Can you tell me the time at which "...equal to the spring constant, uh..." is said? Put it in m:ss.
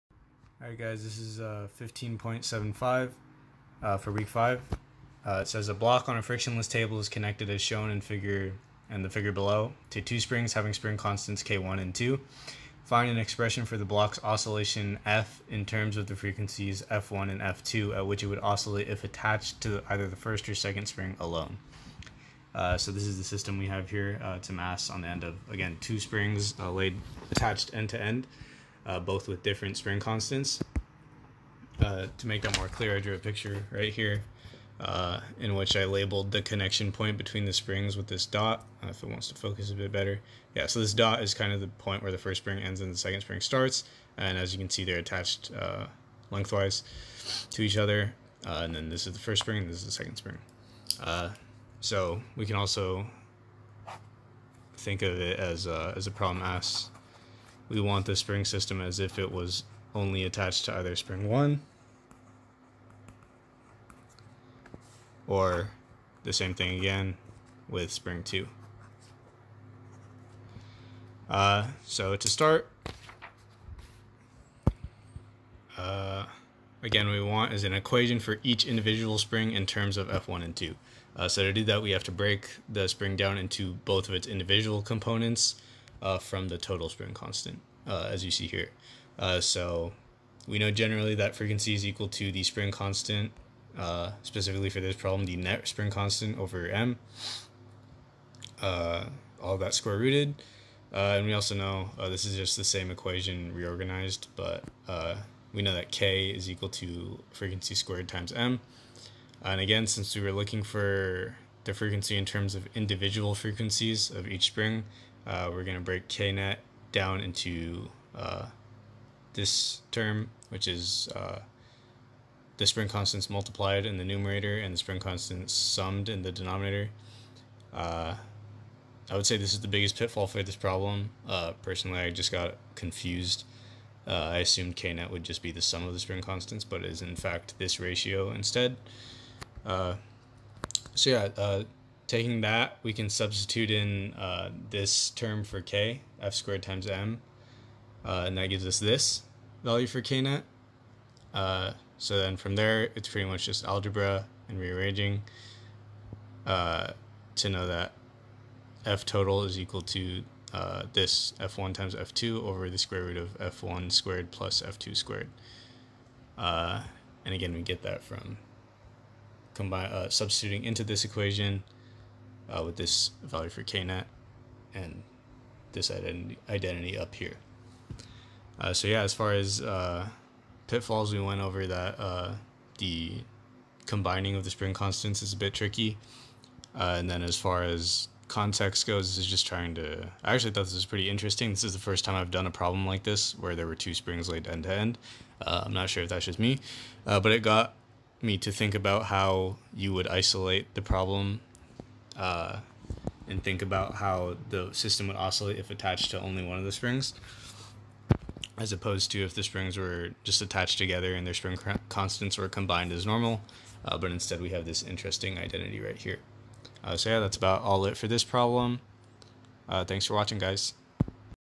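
1:31.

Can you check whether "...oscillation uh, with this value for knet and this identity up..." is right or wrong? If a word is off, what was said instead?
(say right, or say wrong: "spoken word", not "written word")
wrong: "equation", not "oscillation".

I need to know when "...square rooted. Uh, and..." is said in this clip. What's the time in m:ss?
1:39.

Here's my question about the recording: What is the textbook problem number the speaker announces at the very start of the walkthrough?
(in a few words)
15.75.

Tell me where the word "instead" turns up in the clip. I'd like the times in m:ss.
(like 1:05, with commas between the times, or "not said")
2:18, 3:34.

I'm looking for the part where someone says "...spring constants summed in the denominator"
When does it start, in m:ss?
2:04.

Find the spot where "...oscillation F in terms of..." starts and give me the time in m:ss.
0:14.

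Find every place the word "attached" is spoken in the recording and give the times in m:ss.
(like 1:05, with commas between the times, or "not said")
0:19, 0:27, 0:44, 1:00, 3:25, 3:30.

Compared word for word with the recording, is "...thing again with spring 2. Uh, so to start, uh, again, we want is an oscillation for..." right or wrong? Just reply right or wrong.
wrong.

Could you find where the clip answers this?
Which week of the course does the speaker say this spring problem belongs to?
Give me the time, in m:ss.
0:04.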